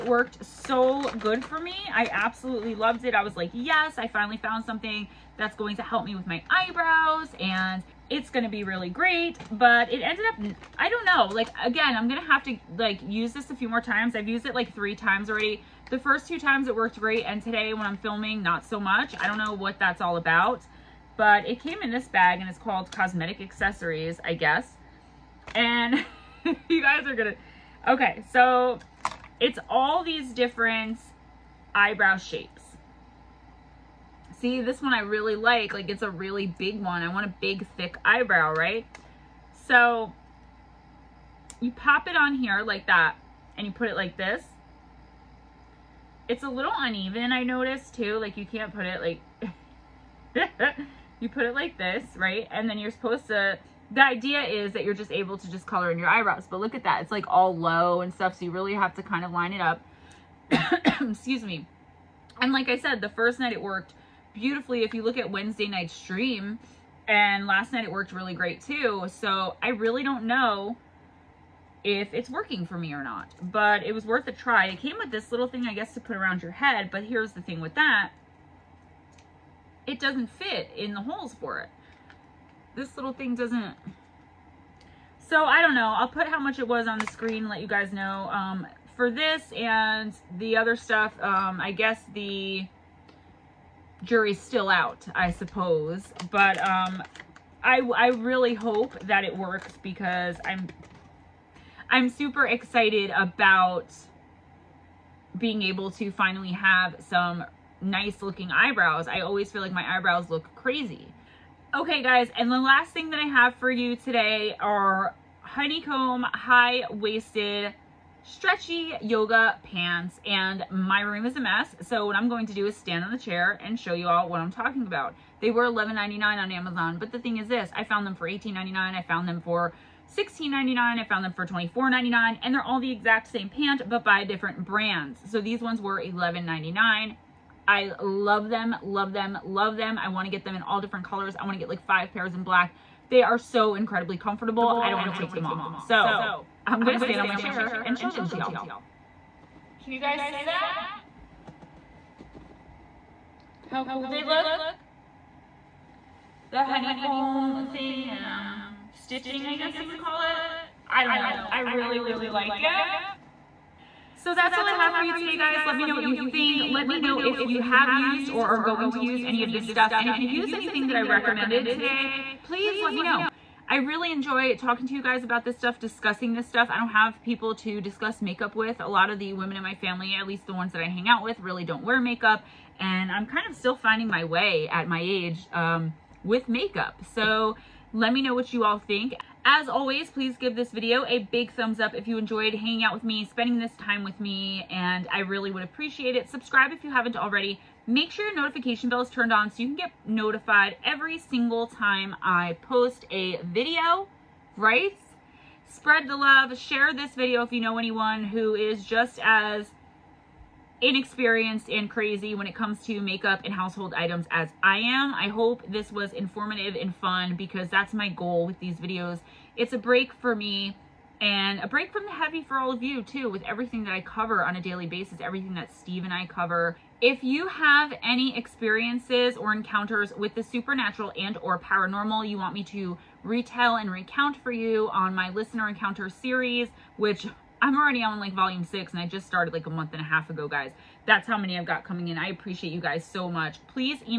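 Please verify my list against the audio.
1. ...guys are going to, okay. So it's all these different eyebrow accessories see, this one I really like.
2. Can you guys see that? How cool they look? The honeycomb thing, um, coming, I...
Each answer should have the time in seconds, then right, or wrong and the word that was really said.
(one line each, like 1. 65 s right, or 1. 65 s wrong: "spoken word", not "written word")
1. 26 s wrong: "shapes", not "accessories"
2. 149 s wrong: "stitching", not "coming".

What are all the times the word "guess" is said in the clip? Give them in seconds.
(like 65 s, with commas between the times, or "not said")
24 s, 75 s, 91 s, 159 s.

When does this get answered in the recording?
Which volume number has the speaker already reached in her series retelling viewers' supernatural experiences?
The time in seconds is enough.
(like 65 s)
238 s.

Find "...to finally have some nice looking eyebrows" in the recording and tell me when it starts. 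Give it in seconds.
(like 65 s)
105 s.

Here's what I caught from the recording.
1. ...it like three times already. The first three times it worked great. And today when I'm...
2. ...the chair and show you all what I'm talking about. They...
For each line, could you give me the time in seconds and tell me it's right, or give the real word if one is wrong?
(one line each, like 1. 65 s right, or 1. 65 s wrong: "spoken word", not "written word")
1. 14 s wrong: "two", not "three"
2. 123 s right.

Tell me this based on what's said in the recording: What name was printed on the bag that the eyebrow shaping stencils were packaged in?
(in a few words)
Cosmetic accessories.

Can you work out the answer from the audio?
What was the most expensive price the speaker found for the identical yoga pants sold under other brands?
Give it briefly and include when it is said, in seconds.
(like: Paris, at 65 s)
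$24.99, at 131 s.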